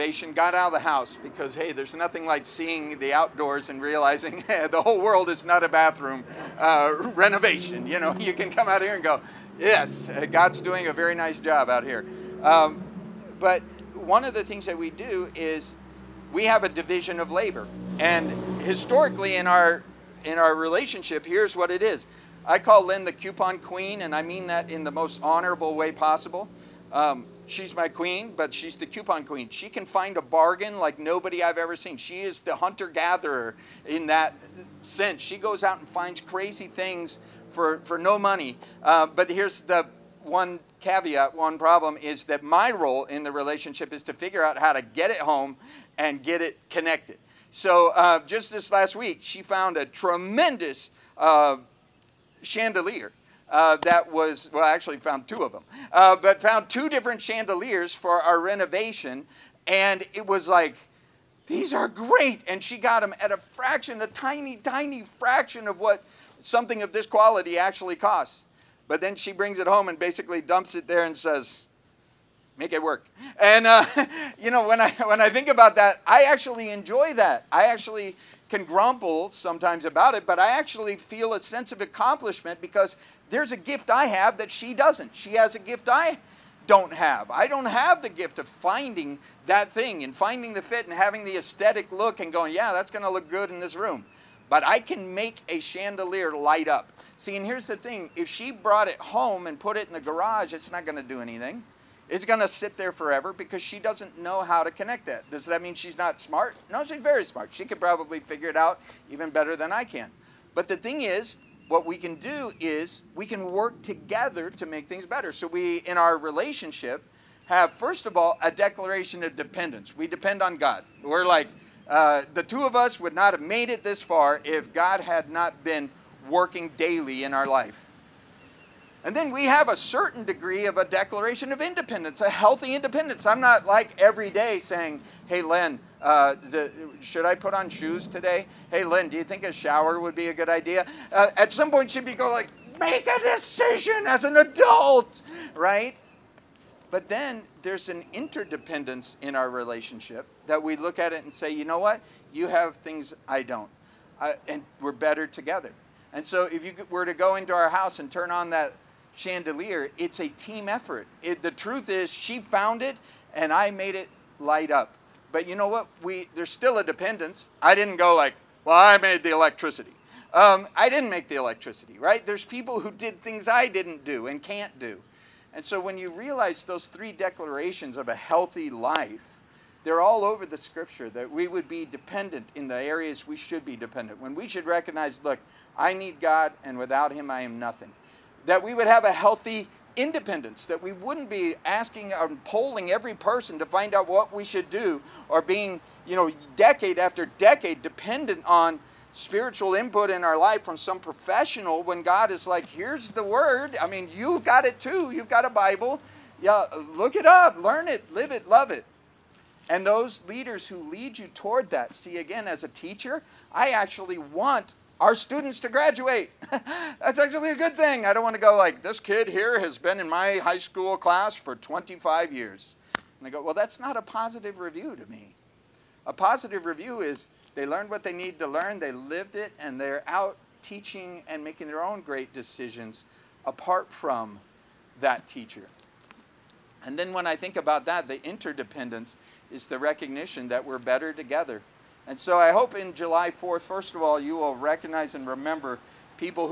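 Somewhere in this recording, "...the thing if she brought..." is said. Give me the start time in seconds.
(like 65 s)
97 s.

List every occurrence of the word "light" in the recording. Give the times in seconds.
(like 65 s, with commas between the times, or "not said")
96 s, 164 s.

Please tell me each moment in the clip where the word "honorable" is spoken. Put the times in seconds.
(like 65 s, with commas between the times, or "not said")
25 s.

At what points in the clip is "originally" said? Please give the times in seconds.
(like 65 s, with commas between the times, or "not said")
not said.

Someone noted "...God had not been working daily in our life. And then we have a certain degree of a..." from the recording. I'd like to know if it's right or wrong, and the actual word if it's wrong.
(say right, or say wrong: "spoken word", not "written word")
right.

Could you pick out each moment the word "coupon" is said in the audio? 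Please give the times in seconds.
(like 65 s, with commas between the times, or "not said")
23 s, 28 s.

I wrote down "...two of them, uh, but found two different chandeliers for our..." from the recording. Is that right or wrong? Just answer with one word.
right.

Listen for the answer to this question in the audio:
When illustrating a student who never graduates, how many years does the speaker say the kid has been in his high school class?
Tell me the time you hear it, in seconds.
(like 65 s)
221 s.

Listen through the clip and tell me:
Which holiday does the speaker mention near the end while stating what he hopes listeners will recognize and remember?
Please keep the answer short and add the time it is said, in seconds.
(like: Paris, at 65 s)
July 4th, at 242 s.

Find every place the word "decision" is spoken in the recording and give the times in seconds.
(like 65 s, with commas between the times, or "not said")
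143 s, 232 s.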